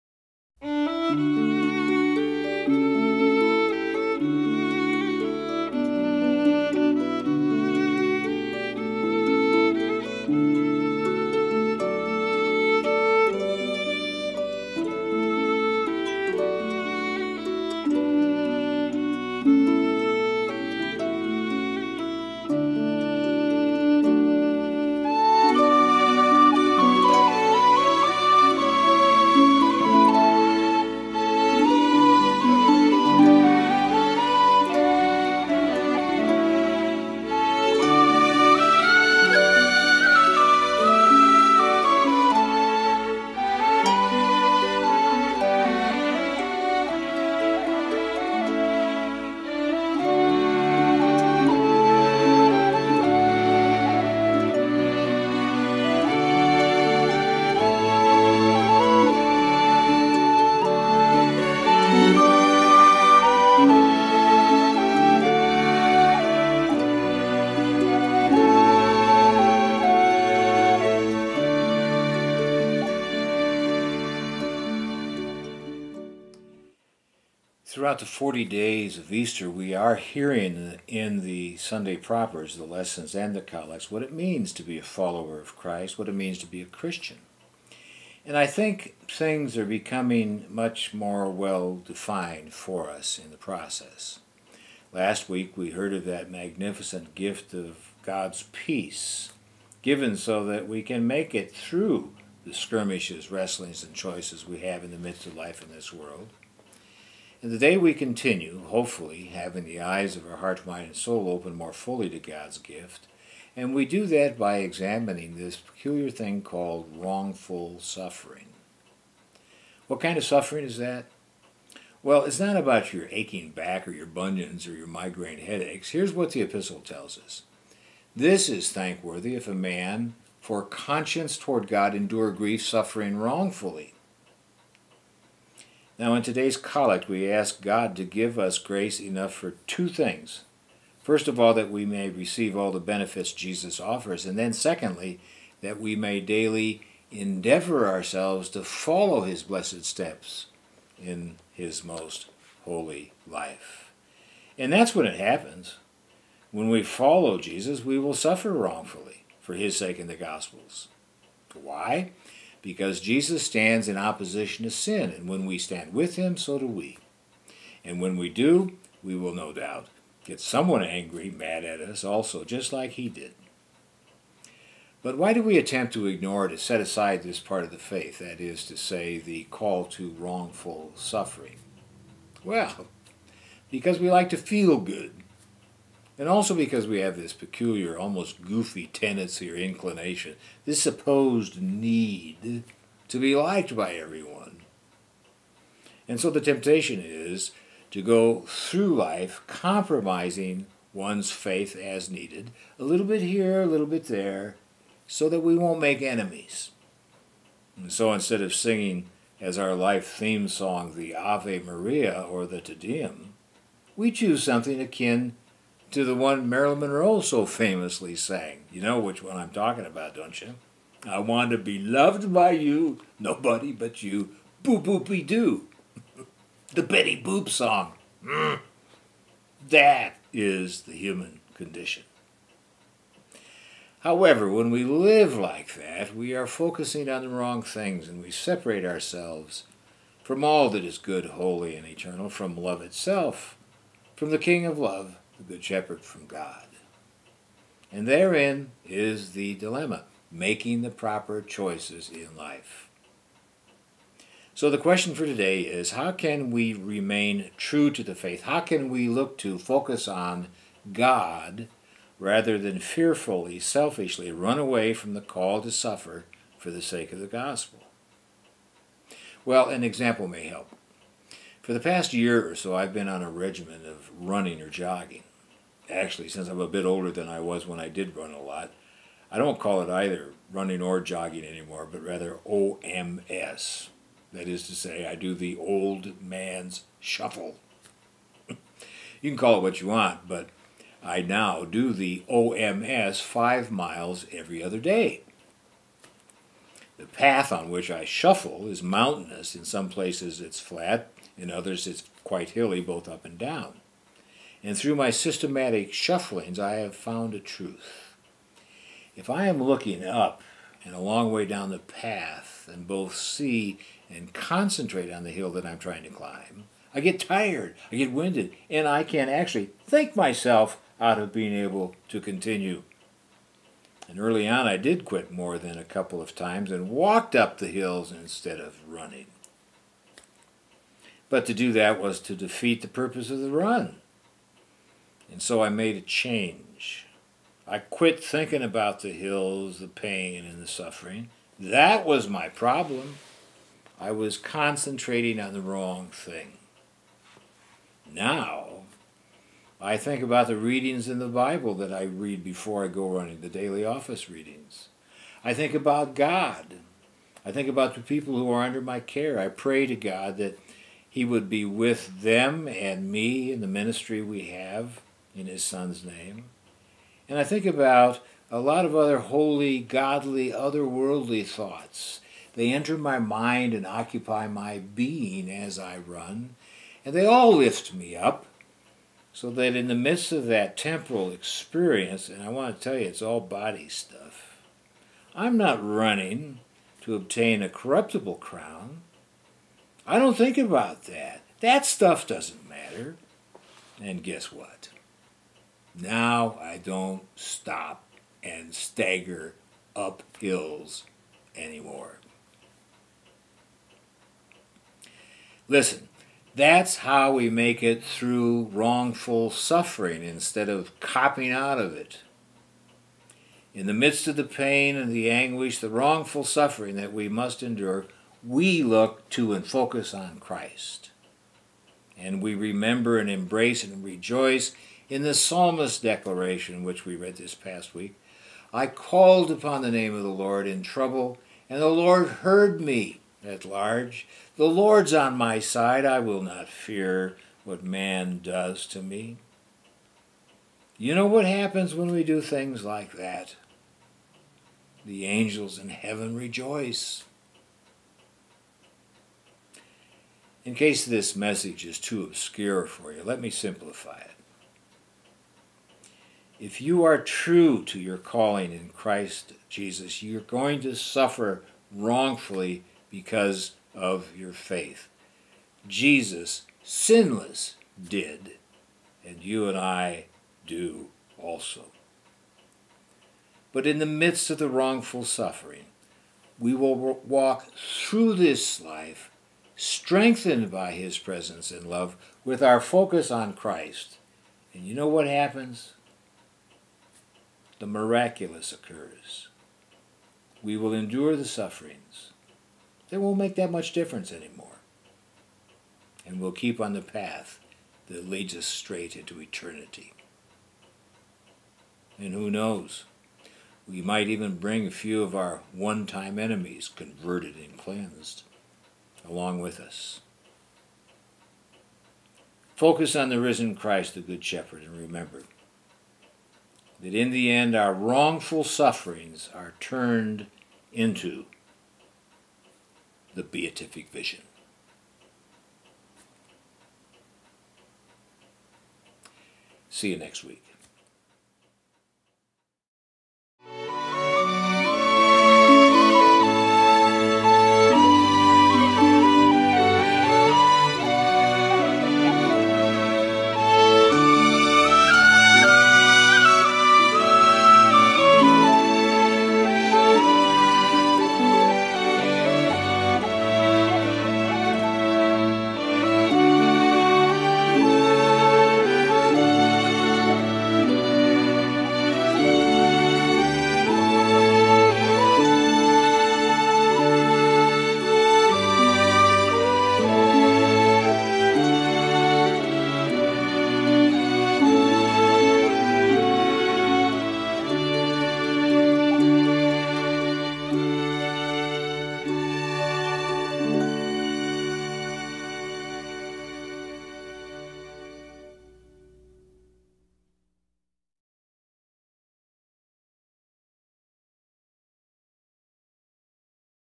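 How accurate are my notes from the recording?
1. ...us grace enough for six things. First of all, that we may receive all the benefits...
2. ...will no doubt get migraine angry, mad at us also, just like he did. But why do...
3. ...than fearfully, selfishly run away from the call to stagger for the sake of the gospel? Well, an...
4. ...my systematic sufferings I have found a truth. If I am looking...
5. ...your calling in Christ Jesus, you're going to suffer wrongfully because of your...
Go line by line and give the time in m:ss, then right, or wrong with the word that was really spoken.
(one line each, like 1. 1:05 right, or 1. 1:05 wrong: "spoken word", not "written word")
1. 2:18 wrong: "two", not "six"
2. 2:49 wrong: "someone", not "migraine"
3. 4:22 wrong: "suffer", not "stagger"
4. 5:04 wrong: "shufflings", not "sufferings"
5. 7:37 right.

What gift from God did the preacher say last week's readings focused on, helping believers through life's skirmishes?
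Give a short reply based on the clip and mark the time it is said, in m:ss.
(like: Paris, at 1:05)
peace, at 1:38.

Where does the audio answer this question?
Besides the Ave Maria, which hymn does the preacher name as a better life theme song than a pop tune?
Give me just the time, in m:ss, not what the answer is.
3:32.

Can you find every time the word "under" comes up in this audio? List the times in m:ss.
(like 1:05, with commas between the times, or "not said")
5:58.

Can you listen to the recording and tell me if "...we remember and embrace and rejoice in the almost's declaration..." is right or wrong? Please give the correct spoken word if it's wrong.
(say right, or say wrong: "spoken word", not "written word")
wrong: "psalmist", not "almost".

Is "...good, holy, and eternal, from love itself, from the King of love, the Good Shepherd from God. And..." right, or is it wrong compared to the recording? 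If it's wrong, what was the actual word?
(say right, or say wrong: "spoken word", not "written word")
right.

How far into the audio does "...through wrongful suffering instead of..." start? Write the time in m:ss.
6:48.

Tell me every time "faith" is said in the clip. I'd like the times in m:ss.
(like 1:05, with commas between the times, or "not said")
2:57, 3:21, 4:18, 7:44.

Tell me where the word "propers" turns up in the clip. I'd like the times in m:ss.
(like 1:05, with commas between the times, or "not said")
1:21, 4:10.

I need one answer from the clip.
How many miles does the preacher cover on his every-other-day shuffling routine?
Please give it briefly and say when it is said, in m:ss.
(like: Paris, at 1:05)
5, at 4:53.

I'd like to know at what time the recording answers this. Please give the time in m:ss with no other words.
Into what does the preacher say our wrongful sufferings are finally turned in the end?
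8:43.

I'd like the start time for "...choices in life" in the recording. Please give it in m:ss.
4:11.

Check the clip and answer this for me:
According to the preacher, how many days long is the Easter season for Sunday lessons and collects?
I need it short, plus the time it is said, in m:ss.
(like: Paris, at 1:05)
40, at 1:18.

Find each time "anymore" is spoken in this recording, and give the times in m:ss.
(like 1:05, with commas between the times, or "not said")
4:41, 6:41, 8:14.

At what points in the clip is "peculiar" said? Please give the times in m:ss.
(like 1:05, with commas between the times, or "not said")
1:55, 3:07.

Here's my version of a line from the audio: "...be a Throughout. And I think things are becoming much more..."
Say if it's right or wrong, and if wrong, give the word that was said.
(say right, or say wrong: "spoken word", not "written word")
wrong: "Christian", not "Throughout".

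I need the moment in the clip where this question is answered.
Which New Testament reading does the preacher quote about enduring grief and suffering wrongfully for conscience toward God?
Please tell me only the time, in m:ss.
2:06.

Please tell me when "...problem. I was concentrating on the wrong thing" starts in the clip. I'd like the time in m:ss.
5:42.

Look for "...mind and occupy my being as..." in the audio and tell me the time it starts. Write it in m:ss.
6:13.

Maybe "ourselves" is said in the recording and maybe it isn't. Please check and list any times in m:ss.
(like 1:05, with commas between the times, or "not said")
2:27, 3:58.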